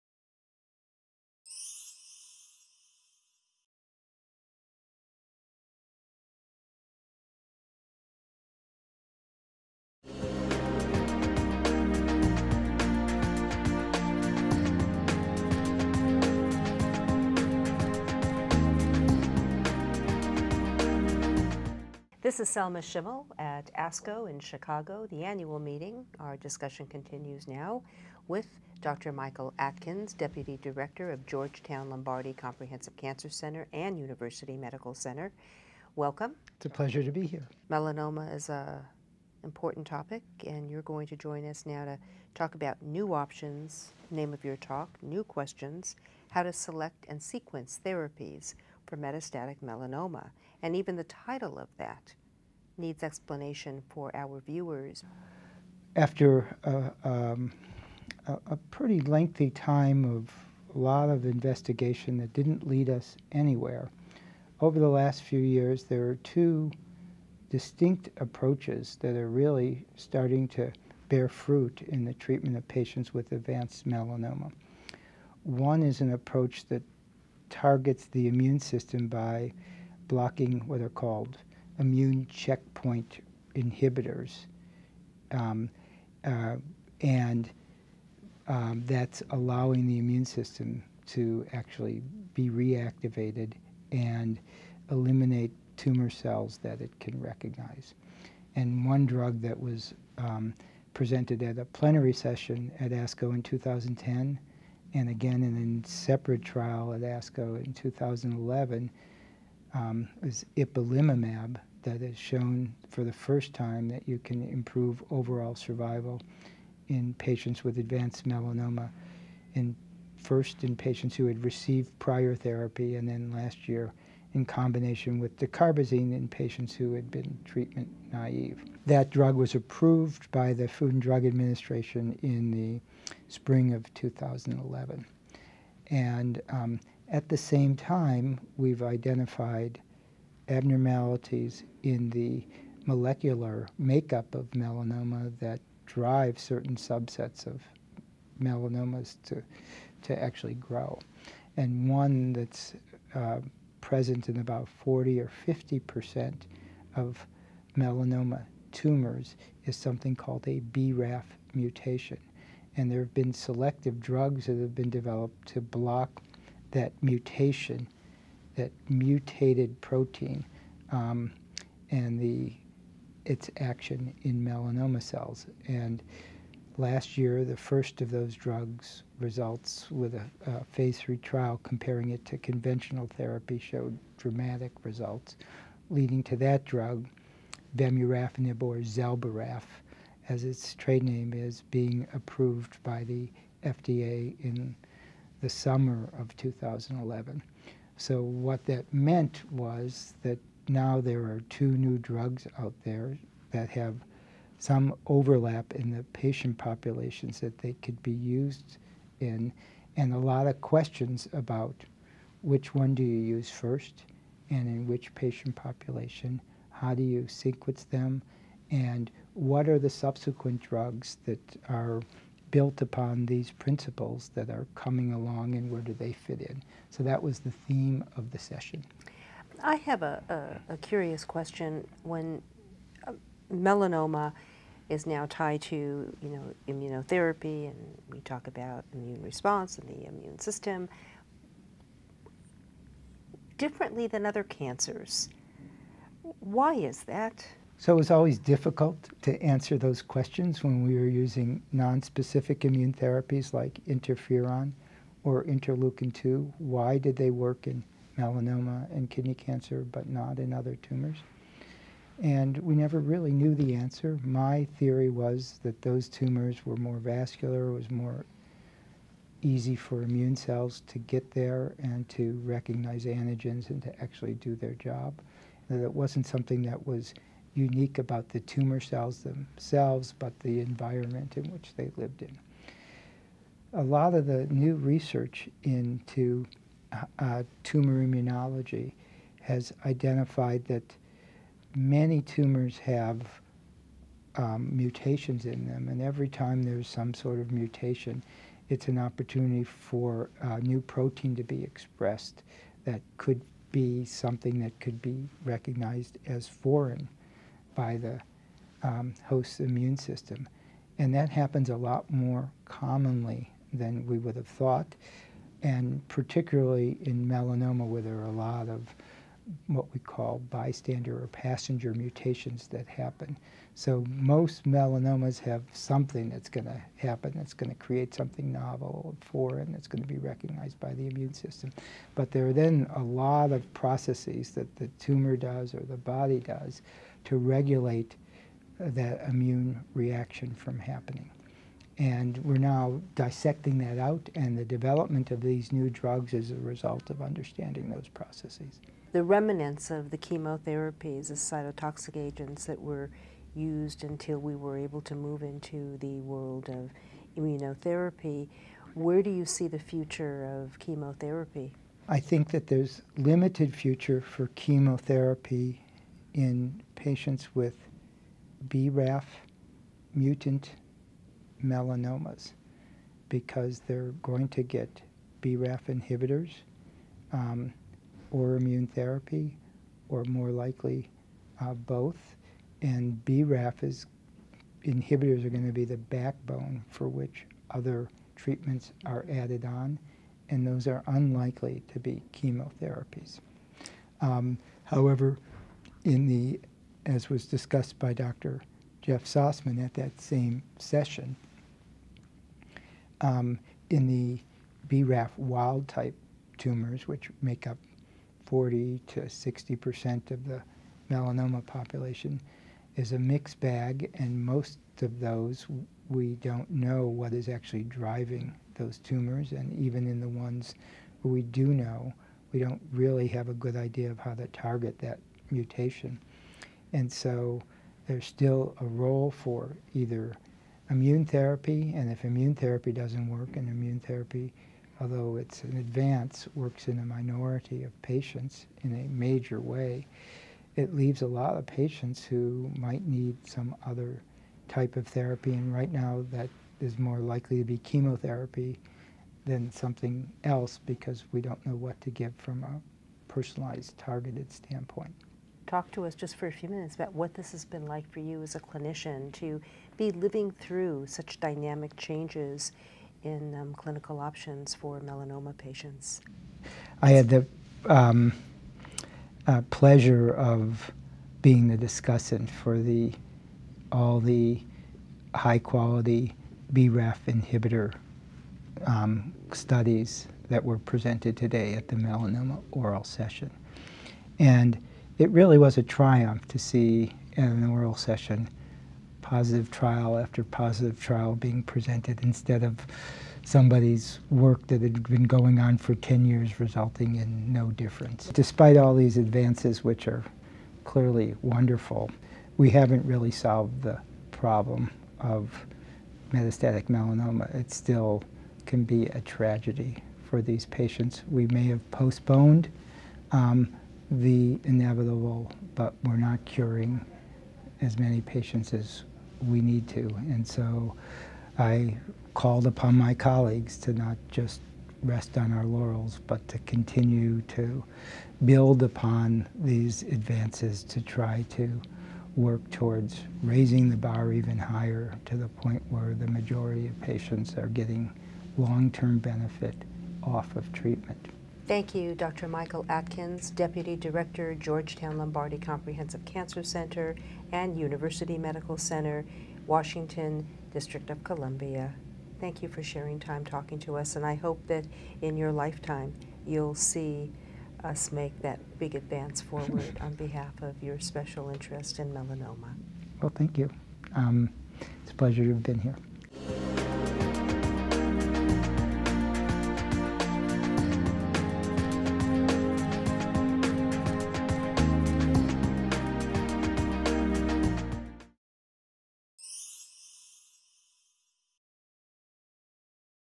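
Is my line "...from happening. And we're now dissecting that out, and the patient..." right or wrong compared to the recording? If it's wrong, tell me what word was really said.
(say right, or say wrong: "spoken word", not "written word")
wrong: "development", not "patient".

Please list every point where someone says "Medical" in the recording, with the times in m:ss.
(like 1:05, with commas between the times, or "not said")
0:34, 9:08.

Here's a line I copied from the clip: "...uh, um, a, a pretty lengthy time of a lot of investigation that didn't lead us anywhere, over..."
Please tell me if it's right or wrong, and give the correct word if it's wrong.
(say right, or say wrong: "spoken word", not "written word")
right.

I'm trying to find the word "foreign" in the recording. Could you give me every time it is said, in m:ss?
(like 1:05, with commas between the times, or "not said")
5:06, 5:29.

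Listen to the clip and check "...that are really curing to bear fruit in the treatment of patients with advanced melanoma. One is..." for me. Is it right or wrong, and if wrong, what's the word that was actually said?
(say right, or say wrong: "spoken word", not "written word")
wrong: "starting", not "curing".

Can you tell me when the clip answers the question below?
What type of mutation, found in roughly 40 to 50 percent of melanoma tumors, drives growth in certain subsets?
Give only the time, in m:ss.
2:40.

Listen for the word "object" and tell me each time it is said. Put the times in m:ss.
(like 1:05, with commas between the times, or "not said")
not said.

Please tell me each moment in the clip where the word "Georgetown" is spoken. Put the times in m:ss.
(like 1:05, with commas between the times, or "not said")
0:31, 9:04.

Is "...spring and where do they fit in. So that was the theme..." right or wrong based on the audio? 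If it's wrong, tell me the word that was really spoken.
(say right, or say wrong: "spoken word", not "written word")
wrong: "along", not "spring".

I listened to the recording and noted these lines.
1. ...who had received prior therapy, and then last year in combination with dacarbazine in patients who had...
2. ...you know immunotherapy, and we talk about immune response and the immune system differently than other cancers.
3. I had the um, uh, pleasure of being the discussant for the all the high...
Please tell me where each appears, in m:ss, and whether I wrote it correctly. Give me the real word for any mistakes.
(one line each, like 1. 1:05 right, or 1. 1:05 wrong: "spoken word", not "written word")
1. 2:01 right
2. 3:56 right
3. 7:47 right.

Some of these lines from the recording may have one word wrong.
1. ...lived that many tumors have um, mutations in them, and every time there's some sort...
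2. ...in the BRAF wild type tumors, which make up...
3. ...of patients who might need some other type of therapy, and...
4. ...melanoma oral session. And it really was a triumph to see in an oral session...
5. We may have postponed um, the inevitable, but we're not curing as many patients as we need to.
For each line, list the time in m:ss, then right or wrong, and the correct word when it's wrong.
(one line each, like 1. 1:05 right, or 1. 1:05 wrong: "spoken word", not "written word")
1. 4:49 wrong: "identified", not "lived"
2. 6:43 right
3. 7:21 right
4. 8:01 right
5. 8:31 right.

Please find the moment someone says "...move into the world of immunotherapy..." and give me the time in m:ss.
5:55.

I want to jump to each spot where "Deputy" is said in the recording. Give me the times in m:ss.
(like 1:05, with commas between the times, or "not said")
0:30, 9:03.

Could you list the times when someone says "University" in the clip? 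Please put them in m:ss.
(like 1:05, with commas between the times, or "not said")
0:33, 9:07.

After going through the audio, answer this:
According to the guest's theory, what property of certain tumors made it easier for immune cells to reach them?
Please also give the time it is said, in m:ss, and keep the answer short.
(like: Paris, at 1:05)
more vascular, at 4:26.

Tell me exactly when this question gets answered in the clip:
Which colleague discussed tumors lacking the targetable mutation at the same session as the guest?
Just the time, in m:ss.
6:39.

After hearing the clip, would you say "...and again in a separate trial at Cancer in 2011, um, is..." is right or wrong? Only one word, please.
wrong.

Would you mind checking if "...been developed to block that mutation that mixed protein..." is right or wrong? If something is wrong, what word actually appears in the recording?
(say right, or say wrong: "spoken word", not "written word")
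wrong: "mutated", not "mixed".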